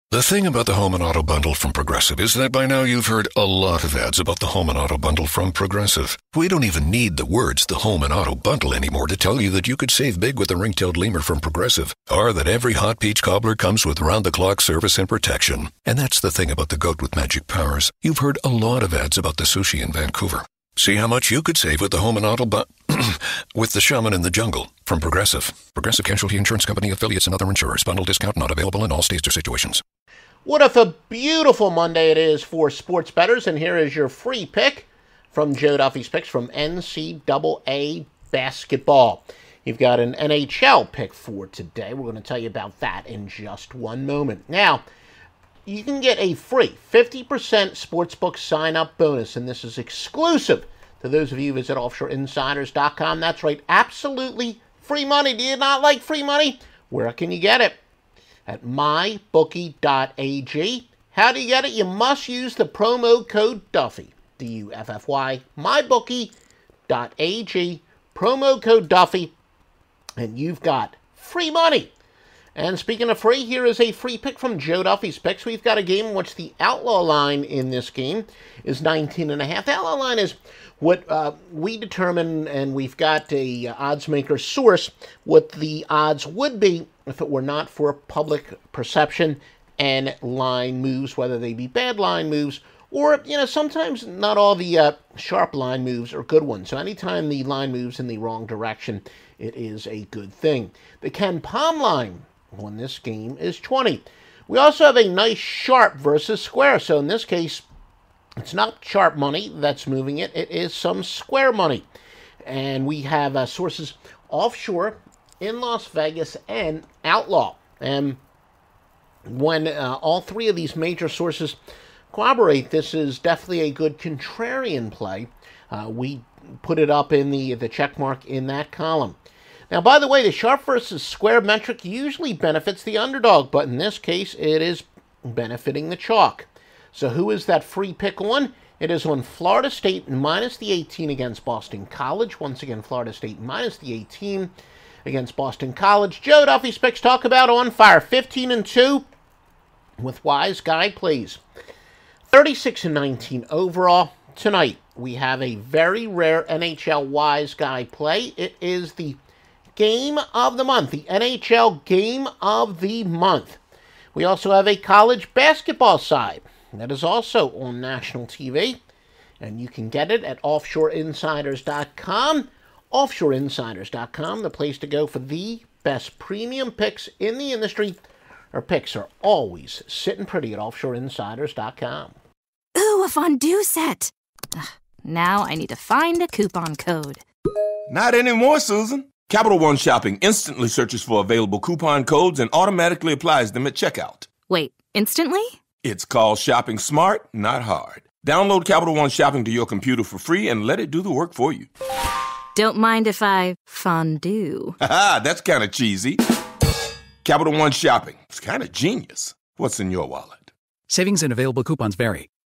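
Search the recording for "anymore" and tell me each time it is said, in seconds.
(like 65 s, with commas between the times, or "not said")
8 s, 188 s.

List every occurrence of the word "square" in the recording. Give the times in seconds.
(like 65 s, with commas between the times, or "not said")
106 s, 111 s, 131 s.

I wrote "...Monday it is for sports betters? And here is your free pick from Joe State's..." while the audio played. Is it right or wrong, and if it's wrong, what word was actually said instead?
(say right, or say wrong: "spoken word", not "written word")
wrong: "Duffy", not "State".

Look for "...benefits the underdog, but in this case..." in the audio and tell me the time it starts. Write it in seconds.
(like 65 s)
132 s.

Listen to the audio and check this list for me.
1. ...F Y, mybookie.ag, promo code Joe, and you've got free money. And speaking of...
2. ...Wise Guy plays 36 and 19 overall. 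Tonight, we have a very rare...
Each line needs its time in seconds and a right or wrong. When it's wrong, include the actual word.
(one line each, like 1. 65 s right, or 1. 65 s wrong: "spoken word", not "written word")
1. 64 s wrong: "Duffy", not "Joe"
2. 150 s right.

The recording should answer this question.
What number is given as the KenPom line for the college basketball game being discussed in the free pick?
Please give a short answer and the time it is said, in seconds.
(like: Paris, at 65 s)
20, at 100 s.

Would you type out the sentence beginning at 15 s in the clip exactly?
And that's the thing about the goat with magic powers.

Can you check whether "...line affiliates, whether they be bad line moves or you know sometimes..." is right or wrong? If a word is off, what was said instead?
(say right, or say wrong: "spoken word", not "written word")
wrong: "moves", not "affiliates".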